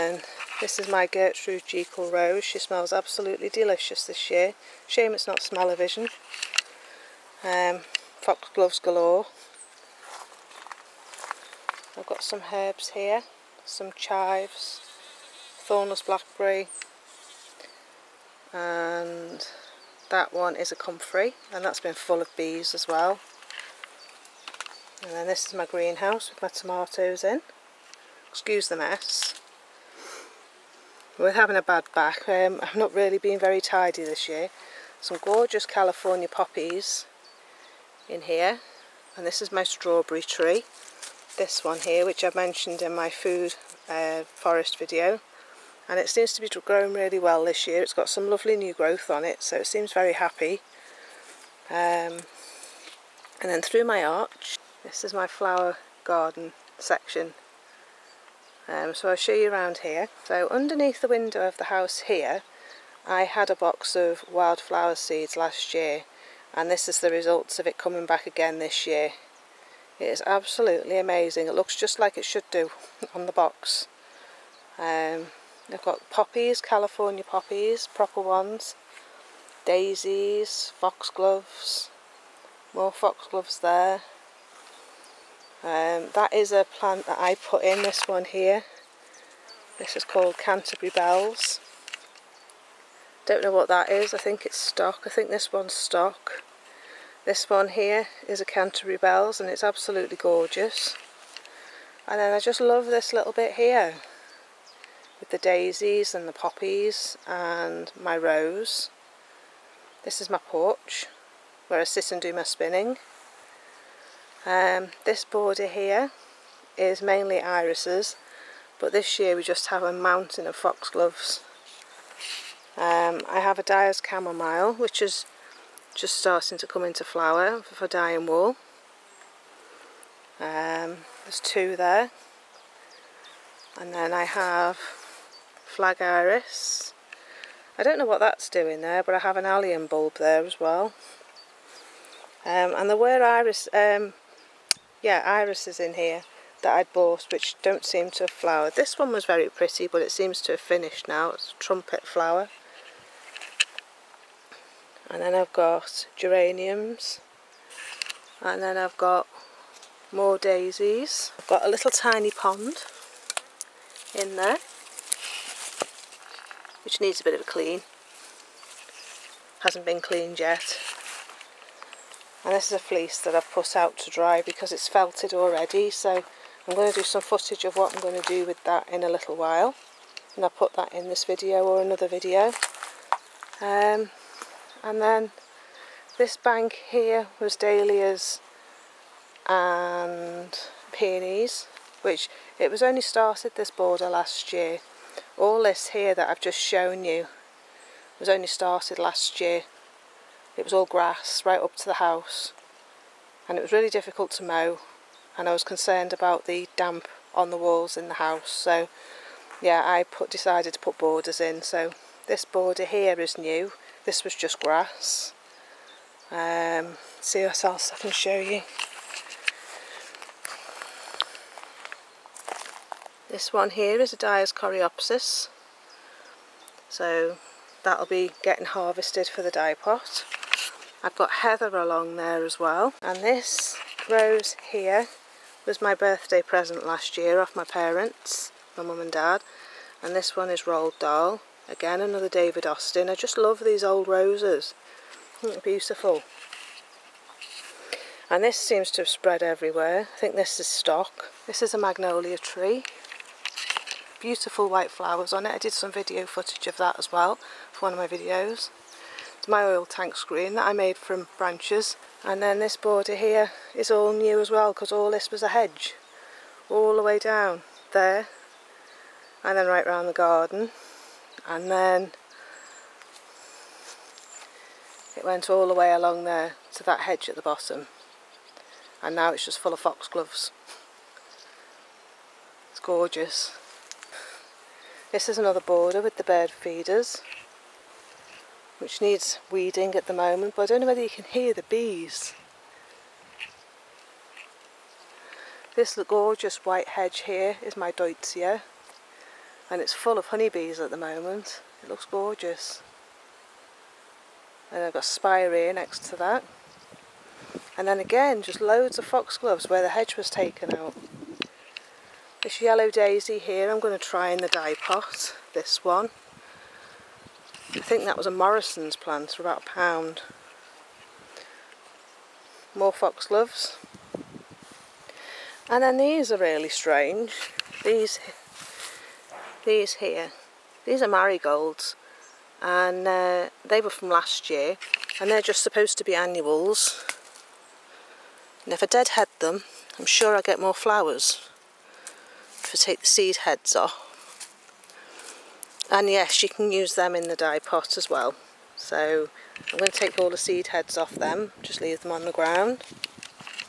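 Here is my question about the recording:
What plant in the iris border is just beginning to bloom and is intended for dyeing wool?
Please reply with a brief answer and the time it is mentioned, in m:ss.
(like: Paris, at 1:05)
Dyer's chamomile, at 2:03.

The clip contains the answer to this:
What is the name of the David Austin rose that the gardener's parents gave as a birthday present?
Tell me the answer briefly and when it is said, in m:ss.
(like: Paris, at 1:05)
Roald Dahl, at 4:00.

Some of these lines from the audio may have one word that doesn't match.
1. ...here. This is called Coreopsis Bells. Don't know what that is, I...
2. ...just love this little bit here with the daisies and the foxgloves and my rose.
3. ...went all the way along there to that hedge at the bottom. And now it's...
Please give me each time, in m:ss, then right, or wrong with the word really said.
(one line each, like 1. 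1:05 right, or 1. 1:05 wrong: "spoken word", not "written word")
1. 1:28 wrong: "Canterbury", not "Coreopsis"
2. 1:42 wrong: "poppies", not "foxgloves"
3. 4:35 right.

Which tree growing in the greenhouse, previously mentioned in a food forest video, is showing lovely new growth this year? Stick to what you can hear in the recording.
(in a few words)
Strawberry tree.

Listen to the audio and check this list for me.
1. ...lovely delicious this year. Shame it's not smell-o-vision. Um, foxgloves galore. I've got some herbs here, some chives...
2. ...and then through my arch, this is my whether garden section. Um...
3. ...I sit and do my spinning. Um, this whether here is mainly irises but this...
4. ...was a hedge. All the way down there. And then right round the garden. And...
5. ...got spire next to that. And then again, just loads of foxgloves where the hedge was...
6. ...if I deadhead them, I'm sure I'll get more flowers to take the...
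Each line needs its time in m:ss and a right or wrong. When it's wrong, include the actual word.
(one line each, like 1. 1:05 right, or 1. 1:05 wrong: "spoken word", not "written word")
1. 0:02 wrong: "absolutely", not "lovely"
2. 0:53 wrong: "flower", not "whether"
3. 1:51 wrong: "border", not "whether"
4. 4:25 right
5. 5:04 right
6. 5:38 right.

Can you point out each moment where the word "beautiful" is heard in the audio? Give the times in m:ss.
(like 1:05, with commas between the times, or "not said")
4:05, 4:14.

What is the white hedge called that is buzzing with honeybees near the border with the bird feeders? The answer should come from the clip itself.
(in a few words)
Deutzia.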